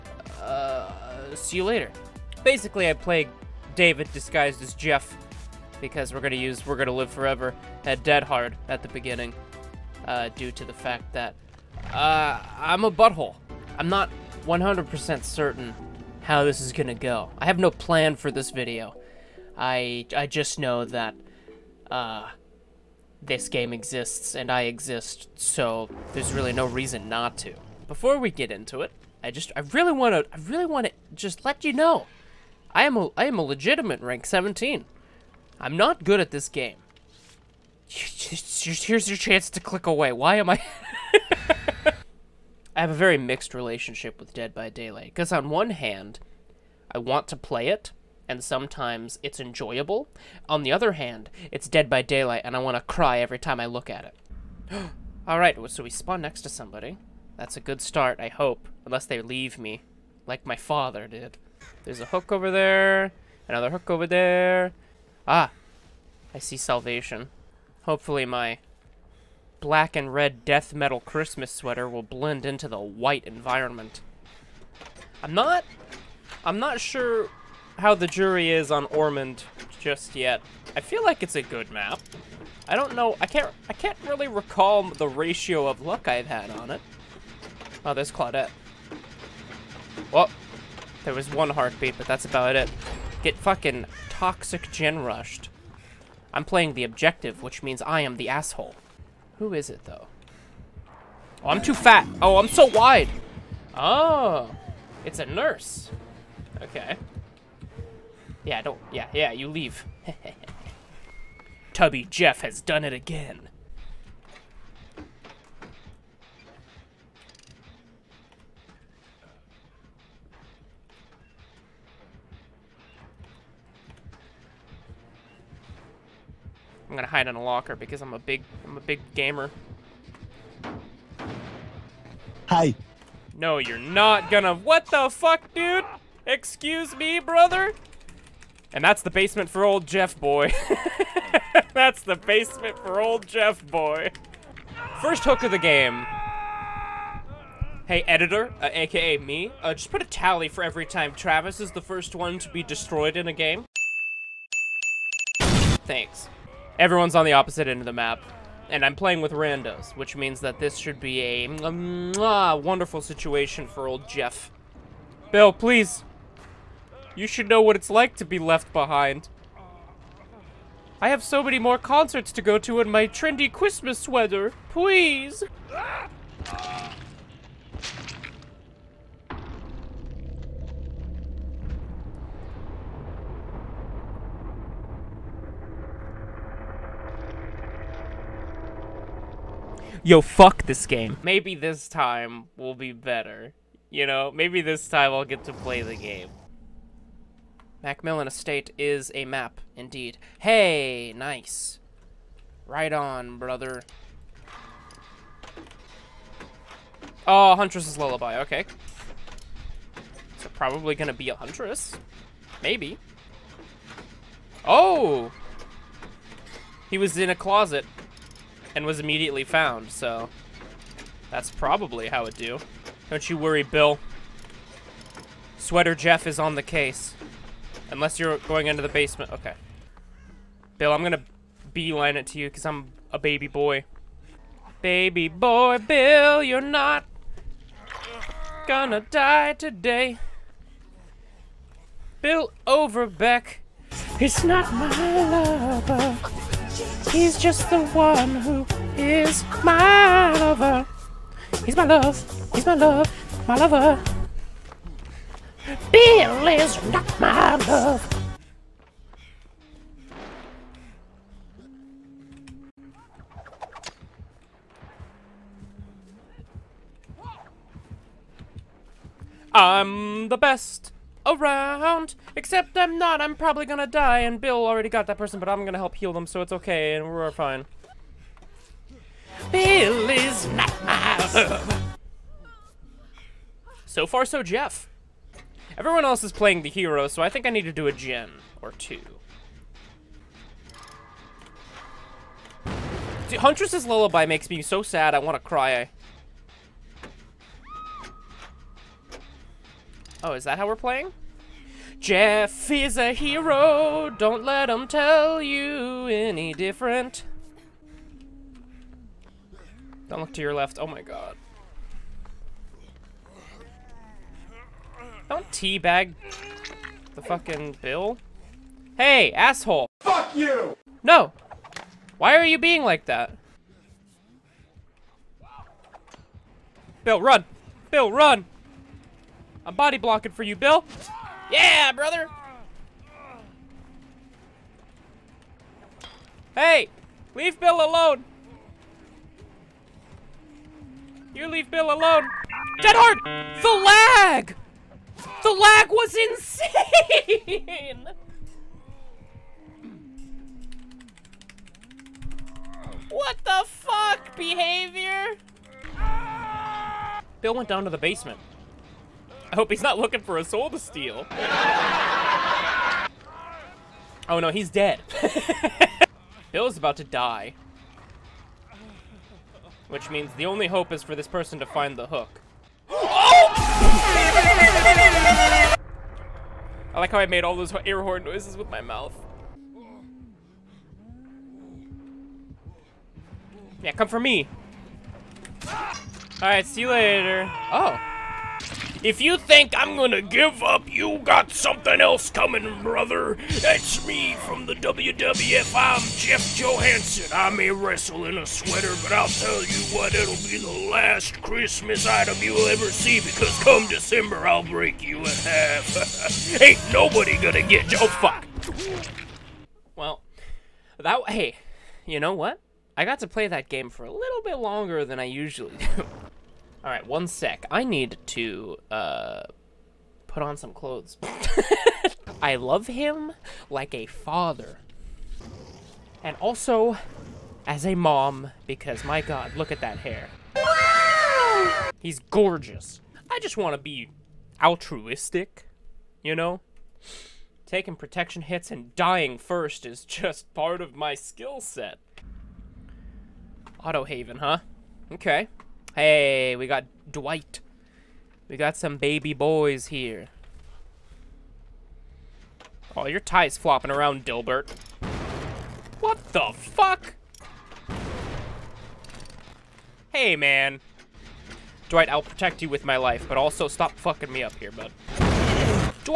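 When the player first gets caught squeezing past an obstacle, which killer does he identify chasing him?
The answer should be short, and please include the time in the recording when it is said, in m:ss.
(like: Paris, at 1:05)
Nurse, at 1:45.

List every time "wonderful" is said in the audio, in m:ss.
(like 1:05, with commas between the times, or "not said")
2:42.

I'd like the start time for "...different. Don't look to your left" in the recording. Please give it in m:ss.
5:06.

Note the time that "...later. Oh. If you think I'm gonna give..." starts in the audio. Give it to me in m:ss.
6:26.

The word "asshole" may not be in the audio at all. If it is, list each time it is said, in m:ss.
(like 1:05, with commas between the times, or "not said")
1:38, 5:19.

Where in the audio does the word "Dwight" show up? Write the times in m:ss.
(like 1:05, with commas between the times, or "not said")
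7:27, 7:41.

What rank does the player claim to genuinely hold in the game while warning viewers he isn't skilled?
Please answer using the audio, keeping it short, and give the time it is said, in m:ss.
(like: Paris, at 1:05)
17, at 0:34.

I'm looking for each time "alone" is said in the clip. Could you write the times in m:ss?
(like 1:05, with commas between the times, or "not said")
5:37, 5:41.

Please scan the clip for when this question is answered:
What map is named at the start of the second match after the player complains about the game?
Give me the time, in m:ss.
3:17.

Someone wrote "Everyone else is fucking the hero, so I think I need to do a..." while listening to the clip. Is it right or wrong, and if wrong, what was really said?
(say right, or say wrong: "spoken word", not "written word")
wrong: "playing", not "fucking".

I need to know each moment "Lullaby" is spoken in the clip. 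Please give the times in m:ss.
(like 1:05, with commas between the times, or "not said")
3:27, 4:53.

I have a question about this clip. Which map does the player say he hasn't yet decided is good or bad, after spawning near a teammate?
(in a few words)
Ormond.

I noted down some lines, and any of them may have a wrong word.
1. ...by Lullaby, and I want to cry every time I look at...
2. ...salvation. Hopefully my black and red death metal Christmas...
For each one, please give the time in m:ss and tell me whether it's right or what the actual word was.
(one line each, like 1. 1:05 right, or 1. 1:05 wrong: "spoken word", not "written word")
1. 0:51 wrong: "Daylight", not "Lullaby"
2. 1:06 right.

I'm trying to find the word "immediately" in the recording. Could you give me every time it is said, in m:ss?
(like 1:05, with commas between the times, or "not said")
3:38.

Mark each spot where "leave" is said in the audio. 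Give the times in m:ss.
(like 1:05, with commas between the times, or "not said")
0:59, 1:49, 5:37, 5:41.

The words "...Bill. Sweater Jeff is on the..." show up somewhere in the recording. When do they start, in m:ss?
3:43.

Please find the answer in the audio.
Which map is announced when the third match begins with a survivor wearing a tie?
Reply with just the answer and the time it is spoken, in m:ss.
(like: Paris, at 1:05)
Autohaven, at 7:23.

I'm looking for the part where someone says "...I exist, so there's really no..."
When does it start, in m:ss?
0:24.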